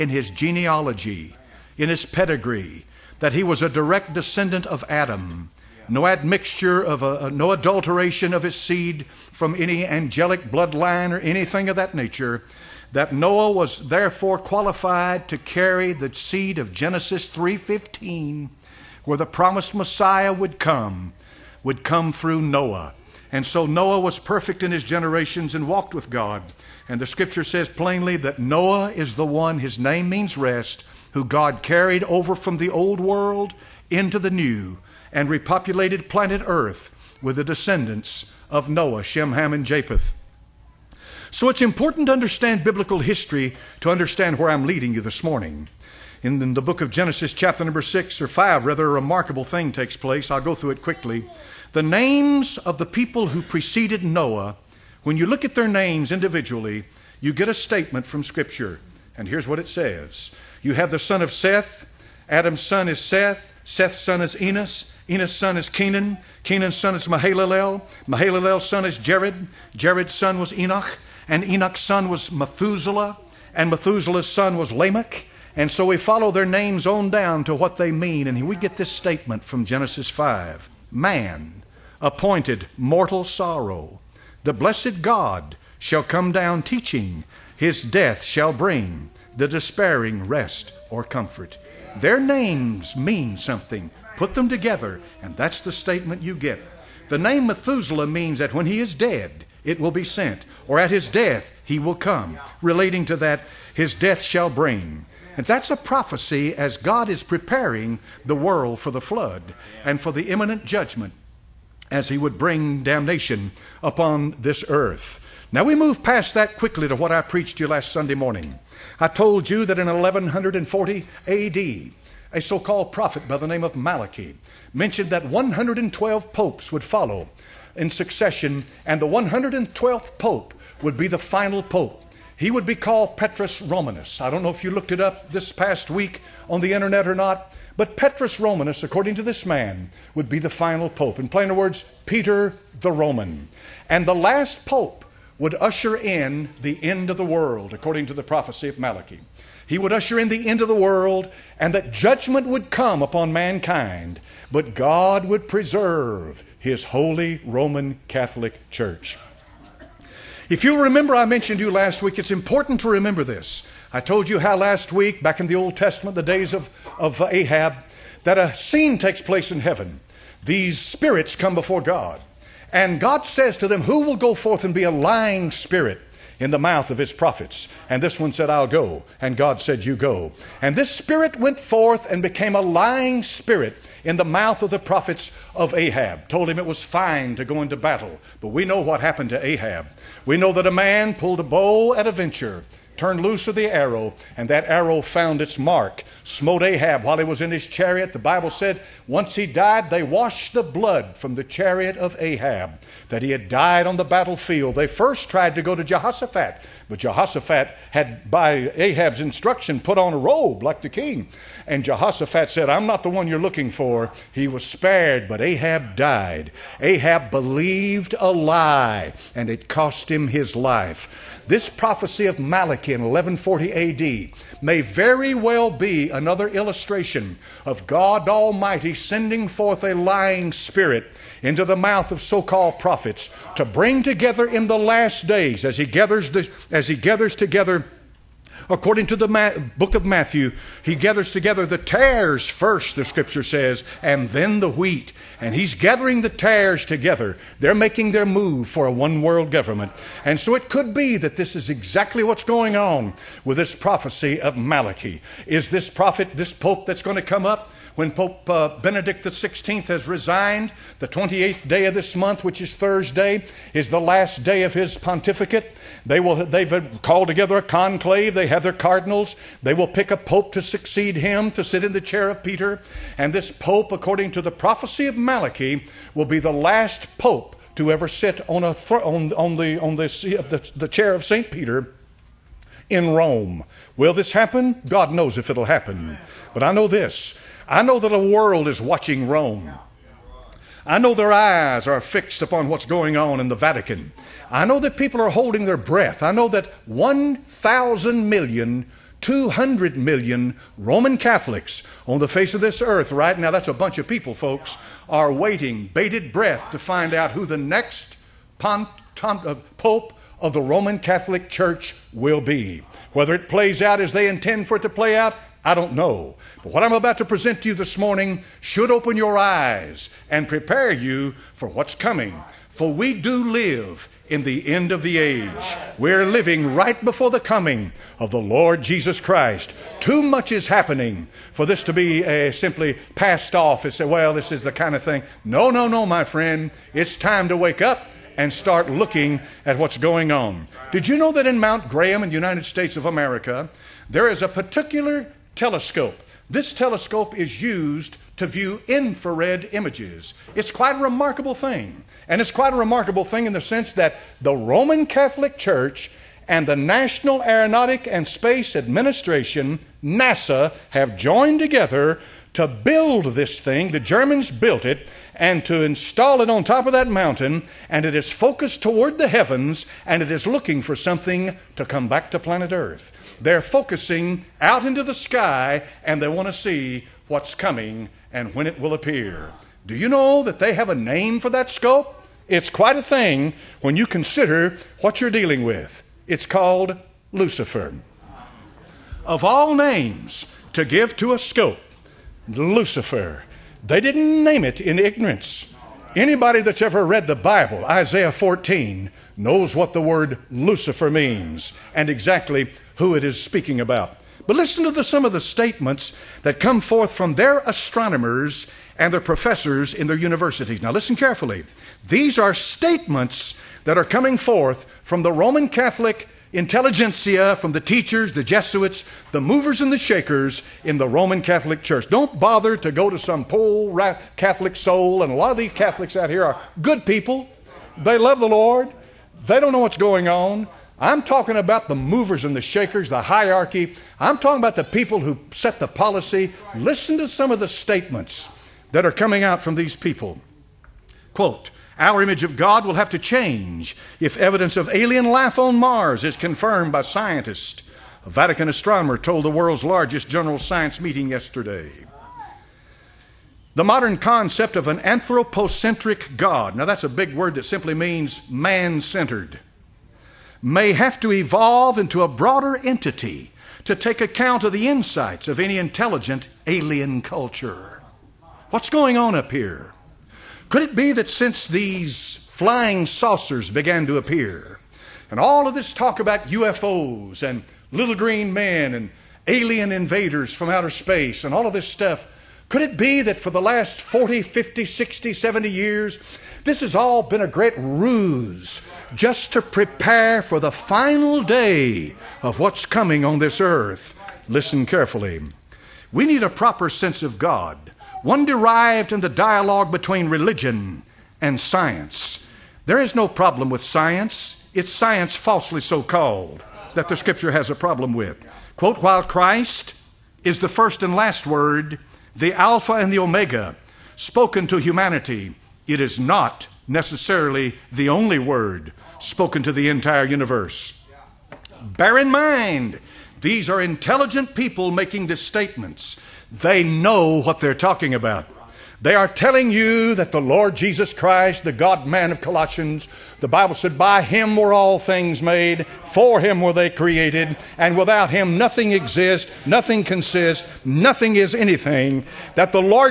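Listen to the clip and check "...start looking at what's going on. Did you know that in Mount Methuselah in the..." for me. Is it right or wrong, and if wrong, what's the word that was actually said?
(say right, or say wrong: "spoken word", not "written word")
wrong: "Graham", not "Methuselah".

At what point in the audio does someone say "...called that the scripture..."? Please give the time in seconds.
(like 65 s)
506 s.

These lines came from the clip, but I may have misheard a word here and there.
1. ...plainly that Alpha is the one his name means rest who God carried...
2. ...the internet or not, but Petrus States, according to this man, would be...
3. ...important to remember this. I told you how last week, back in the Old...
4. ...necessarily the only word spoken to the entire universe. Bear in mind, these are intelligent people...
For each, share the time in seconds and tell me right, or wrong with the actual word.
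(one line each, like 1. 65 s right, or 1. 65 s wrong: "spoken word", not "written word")
1. 27 s wrong: "Noah", not "Alpha"
2. 136 s wrong: "Romanus", not "States"
3. 162 s right
4. 516 s right.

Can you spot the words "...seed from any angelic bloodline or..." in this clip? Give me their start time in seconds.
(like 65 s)
8 s.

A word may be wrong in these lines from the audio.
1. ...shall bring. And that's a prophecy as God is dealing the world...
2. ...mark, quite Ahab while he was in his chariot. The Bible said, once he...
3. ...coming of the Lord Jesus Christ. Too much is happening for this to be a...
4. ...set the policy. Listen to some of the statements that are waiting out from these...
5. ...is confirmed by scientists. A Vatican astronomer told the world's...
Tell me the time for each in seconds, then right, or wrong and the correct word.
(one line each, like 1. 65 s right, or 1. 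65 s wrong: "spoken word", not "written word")
1. 104 s wrong: "preparing", not "dealing"
2. 195 s wrong: "smote", not "quite"
3. 327 s right
4. 435 s wrong: "coming", not "waiting"
5. 446 s right.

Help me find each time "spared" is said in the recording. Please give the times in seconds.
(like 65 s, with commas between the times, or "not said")
214 s.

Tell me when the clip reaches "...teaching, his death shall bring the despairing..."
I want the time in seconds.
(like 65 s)
86 s.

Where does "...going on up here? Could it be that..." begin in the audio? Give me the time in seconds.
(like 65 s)
468 s.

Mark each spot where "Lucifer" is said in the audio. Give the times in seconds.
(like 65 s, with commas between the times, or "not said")
387 s, 392 s, 400 s.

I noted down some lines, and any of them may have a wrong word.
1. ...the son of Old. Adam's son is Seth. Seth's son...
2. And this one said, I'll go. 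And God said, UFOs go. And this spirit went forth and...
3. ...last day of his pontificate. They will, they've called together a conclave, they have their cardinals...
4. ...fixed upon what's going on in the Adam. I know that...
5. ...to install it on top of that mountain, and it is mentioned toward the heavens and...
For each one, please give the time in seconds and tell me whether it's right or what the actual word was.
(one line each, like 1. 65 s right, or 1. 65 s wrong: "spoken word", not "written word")
1. 60 s wrong: "Seth", not "Old"
2. 177 s wrong: "You", not "UFOs"
3. 263 s right
4. 292 s wrong: "Vatican", not "Adam"
5. 365 s wrong: "focused", not "mentioned".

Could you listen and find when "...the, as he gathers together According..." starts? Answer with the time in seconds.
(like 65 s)
236 s.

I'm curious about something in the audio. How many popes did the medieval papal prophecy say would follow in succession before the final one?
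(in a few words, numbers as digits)
112.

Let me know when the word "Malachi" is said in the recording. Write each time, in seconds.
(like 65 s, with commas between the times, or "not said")
123 s, 148 s, 222 s, 254 s, 275 s.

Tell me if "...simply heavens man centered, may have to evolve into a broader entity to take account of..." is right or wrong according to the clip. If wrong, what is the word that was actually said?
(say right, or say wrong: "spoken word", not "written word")
wrong: "means", not "heavens".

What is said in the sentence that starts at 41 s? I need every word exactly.
So it's important to understand biblical history to understand where I'm leading you this morning.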